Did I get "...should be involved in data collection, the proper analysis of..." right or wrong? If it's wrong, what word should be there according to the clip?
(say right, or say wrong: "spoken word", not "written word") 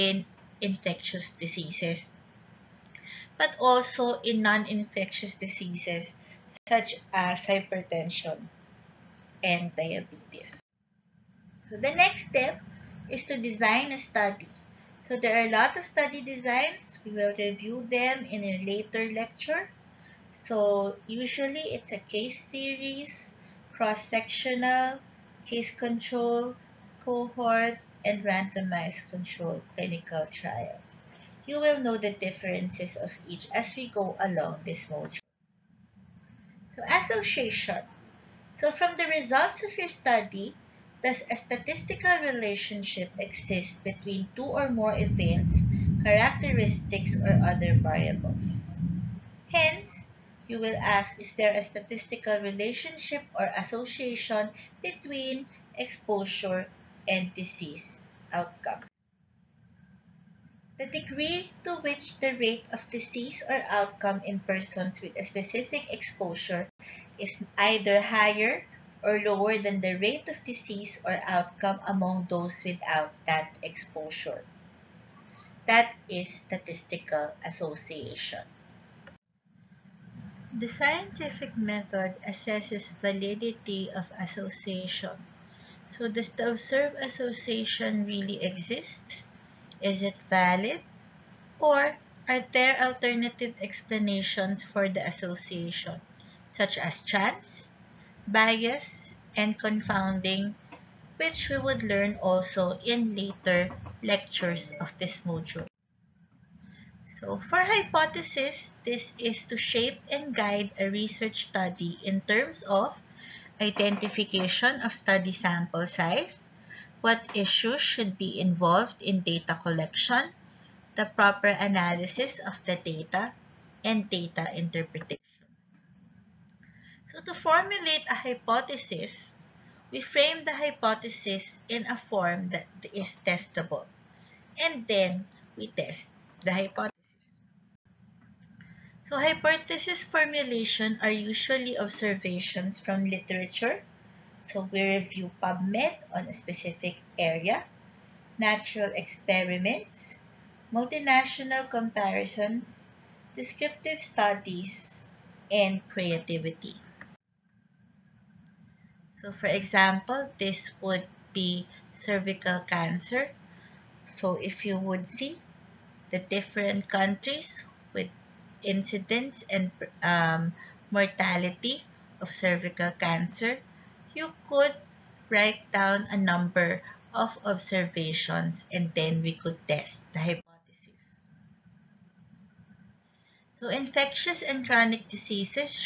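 right.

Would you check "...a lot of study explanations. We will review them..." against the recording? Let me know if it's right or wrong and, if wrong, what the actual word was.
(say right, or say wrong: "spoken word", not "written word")
wrong: "designs", not "explanations".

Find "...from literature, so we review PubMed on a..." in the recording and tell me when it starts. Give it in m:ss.
2:22.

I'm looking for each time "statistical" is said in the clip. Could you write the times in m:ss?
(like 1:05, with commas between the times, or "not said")
0:41, 0:51, 1:16.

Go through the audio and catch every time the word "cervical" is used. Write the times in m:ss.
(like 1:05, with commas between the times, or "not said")
2:41, 2:52.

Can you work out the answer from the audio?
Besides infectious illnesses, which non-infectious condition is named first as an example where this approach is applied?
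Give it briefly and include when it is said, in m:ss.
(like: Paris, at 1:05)
Hypertension, at 0:07.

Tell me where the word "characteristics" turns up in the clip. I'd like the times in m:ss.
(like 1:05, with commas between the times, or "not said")
0:46.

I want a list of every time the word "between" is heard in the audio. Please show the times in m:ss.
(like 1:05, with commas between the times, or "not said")
0:43, 0:54.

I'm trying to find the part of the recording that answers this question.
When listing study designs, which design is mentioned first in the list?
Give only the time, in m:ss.
0:21.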